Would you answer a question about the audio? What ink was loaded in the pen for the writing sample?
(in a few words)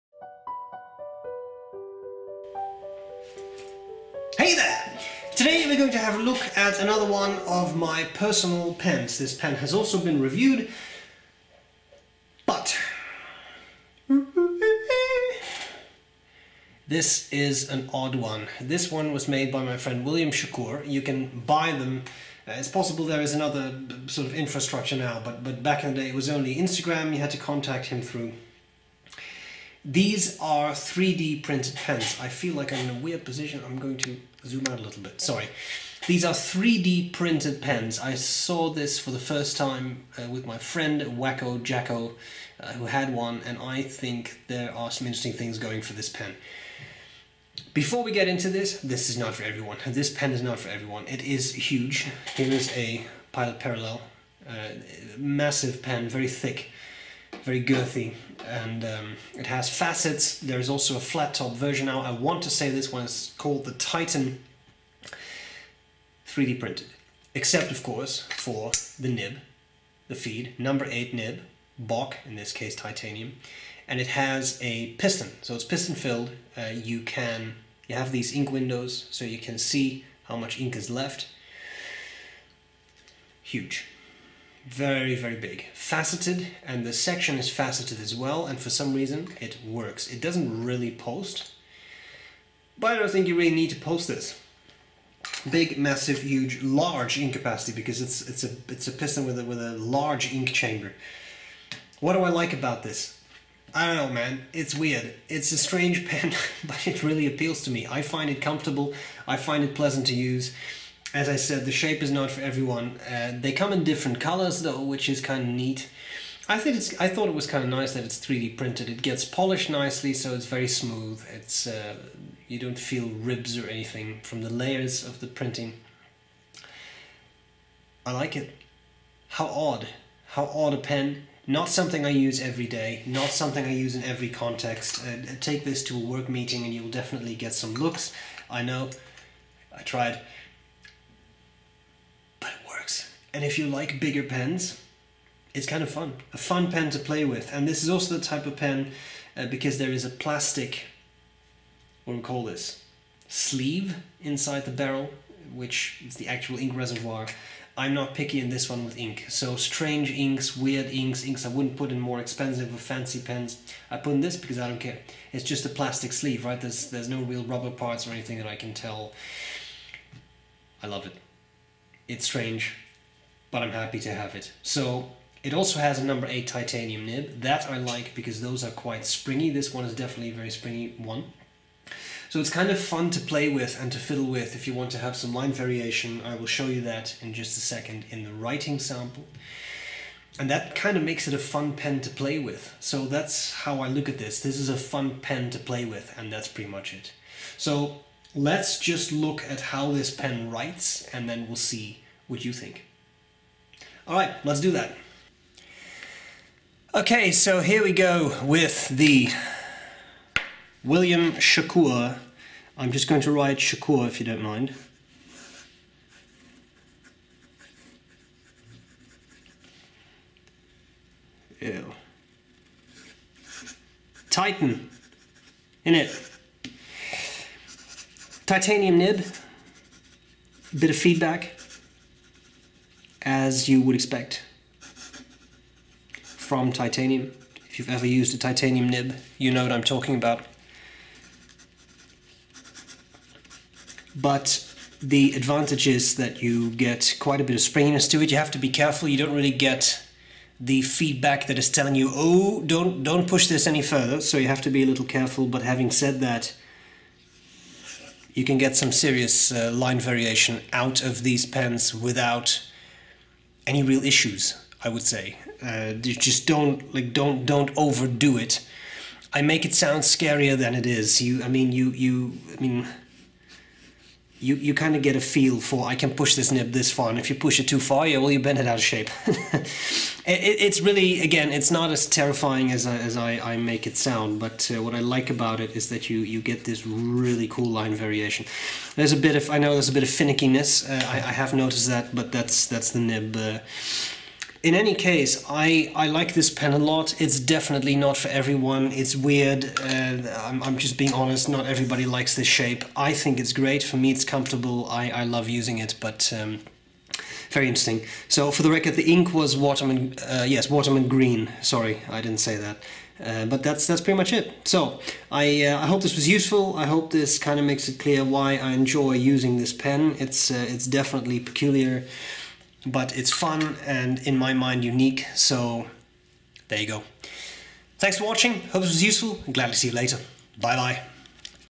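Waterman Green.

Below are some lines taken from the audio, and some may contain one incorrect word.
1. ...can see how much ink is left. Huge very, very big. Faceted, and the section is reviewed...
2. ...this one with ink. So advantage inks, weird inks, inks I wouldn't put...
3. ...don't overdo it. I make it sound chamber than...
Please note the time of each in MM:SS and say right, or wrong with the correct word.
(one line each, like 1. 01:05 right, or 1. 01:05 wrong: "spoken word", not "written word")
1. 01:19 wrong: "faceted", not "reviewed"
2. 02:38 wrong: "strange", not "advantage"
3. 04:27 wrong: "scarier", not "chamber".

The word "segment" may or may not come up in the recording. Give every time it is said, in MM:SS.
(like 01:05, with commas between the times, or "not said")
not said.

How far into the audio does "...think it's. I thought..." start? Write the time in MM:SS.
01:56.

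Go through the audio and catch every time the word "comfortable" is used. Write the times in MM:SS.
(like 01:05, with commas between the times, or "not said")
01:48, 05:04.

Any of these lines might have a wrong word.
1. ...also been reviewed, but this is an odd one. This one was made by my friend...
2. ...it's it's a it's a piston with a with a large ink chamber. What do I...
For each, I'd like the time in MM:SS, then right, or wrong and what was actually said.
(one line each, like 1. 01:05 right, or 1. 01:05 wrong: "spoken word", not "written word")
1. 00:09 right
2. 01:38 right.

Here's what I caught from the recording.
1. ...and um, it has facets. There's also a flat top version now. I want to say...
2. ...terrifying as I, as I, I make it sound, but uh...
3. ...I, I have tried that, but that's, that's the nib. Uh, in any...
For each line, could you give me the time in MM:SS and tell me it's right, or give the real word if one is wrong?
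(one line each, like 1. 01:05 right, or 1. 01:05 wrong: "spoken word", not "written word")
1. 00:58 right
2. 04:42 right
3. 04:51 wrong: "noticed", not "tried".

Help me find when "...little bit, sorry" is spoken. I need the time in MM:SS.
00:34.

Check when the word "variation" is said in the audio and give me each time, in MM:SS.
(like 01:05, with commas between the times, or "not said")
03:05, 04:19, 04:47.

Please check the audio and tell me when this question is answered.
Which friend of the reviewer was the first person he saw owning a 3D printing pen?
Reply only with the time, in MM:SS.
00:41.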